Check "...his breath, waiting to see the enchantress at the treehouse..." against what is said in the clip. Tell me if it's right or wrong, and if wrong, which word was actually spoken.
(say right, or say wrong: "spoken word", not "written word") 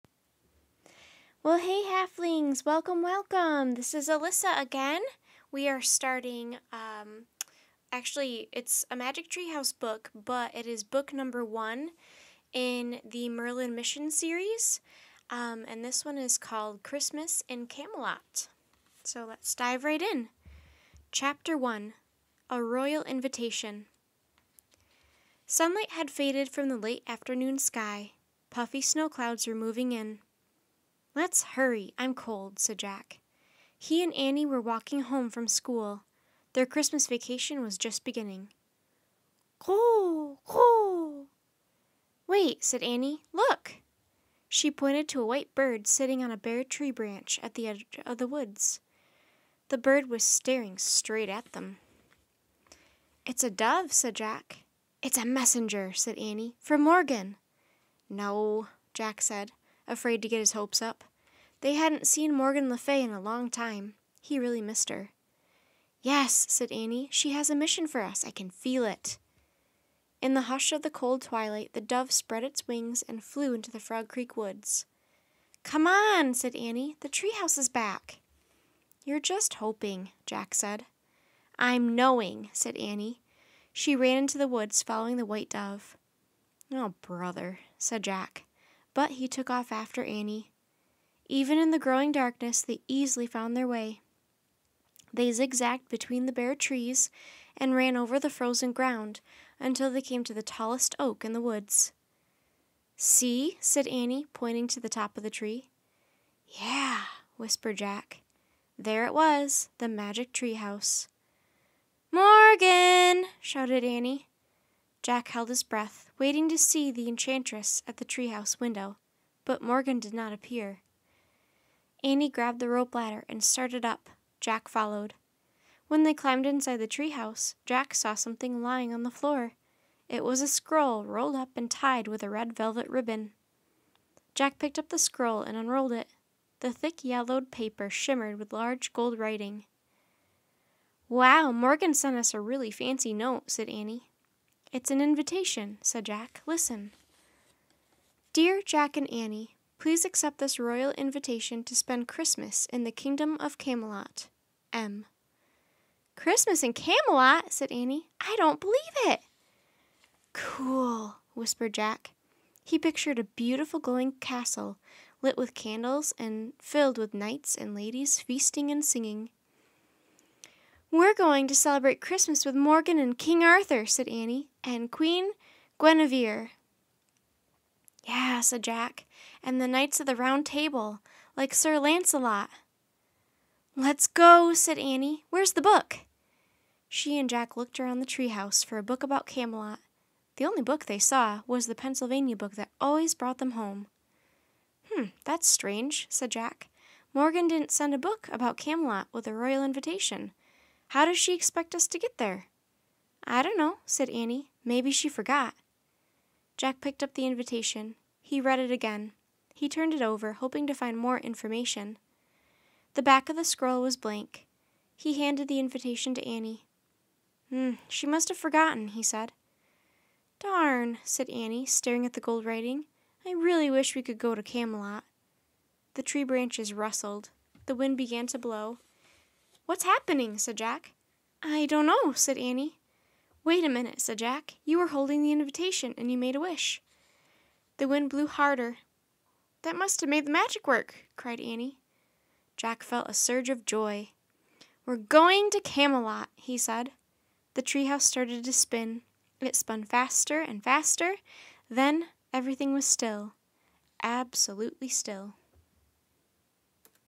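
right.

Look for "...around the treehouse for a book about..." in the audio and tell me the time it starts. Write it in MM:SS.
03:07.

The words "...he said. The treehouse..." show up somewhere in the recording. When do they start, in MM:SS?
04:06.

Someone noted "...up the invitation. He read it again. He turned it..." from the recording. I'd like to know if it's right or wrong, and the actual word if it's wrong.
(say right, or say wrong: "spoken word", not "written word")
right.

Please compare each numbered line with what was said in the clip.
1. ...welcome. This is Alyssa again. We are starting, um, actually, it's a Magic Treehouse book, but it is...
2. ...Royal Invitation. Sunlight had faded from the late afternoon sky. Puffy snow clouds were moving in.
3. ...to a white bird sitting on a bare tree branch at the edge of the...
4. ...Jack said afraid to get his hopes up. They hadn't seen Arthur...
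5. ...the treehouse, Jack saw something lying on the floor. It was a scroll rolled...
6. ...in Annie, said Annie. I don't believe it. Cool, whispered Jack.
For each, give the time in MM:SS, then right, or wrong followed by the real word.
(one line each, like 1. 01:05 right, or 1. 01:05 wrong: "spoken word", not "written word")
1. 00:03 right
2. 00:22 right
3. 00:45 right
4. 00:58 wrong: "Morgan", not "Arthur"
5. 02:06 right
6. 02:36 wrong: "Camelot", not "Annie".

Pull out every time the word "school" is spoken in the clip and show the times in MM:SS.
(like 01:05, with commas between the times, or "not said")
00:35.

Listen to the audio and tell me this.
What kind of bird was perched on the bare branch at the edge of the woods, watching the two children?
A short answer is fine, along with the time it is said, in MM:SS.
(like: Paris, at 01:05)
A dove, at 00:53.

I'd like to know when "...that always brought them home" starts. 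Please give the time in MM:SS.
03:12.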